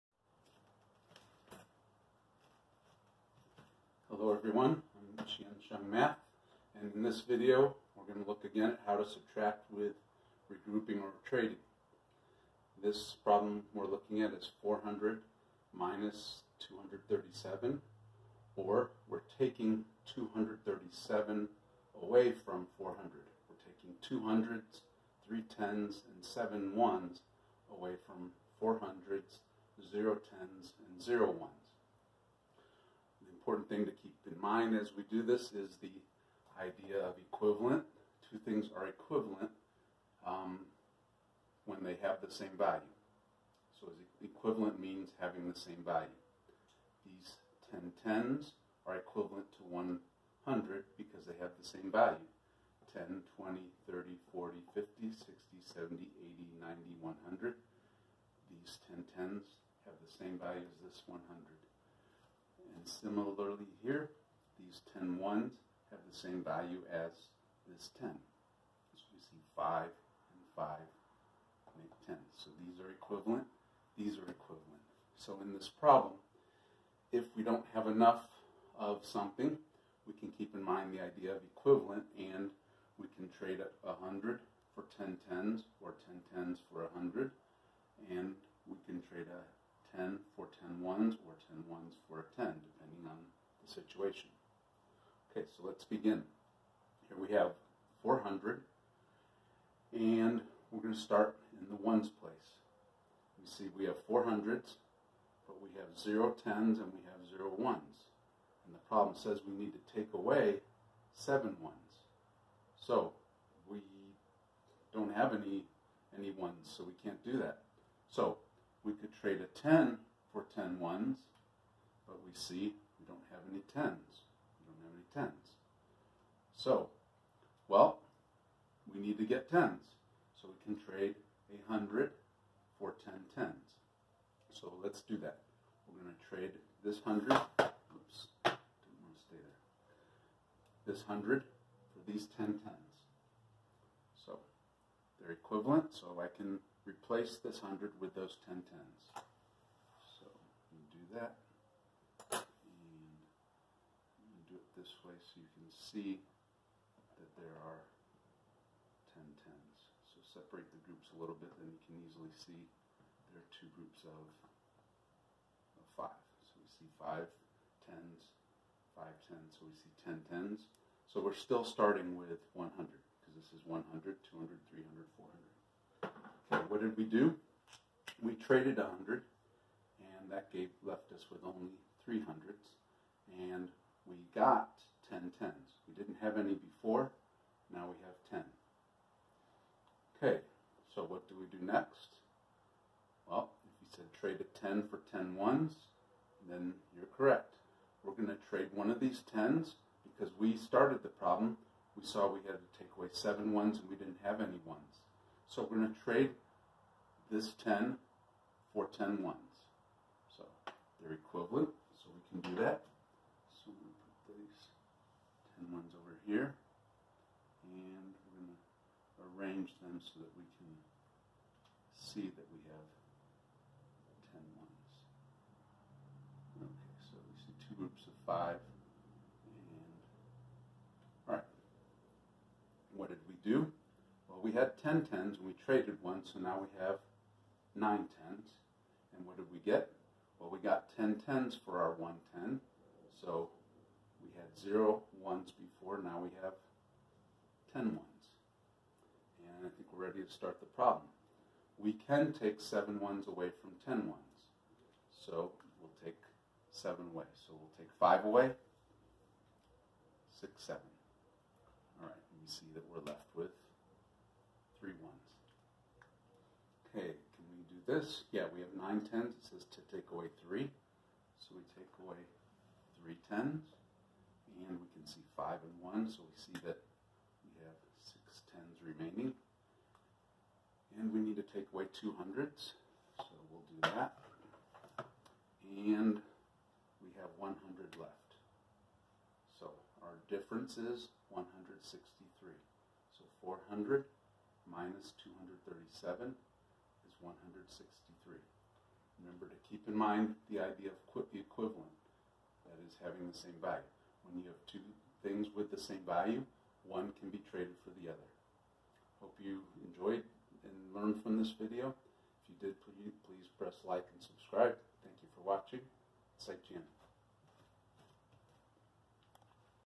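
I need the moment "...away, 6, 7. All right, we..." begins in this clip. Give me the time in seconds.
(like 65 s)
258 s.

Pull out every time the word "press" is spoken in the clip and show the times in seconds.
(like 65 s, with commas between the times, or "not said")
313 s.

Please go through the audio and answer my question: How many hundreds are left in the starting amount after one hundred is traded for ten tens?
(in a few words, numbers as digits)
300.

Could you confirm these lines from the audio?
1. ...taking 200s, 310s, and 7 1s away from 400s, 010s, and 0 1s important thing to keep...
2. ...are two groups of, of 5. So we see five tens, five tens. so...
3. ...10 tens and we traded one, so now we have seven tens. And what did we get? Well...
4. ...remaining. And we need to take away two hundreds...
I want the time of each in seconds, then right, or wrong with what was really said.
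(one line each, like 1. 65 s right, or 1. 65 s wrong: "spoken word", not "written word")
1. 23 s right
2. 163 s right
3. 234 s wrong: "nine", not "seven"
4. 278 s right.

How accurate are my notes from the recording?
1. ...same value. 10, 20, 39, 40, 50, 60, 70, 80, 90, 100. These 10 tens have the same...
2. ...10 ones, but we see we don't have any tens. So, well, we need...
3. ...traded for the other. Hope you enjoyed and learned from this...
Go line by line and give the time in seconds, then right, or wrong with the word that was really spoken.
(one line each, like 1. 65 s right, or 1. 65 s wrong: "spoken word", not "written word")
1. 51 s wrong: "30", not "39"
2. 120 s right
3. 307 s right.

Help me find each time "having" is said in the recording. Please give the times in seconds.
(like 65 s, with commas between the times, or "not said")
45 s, 303 s.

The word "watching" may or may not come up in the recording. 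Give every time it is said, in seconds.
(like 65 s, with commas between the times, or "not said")
315 s.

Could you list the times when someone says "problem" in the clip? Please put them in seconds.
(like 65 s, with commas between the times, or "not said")
13 s, 75 s, 108 s, 201 s, 250 s.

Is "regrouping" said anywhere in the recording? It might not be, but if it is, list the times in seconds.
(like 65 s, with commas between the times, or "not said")
10 s.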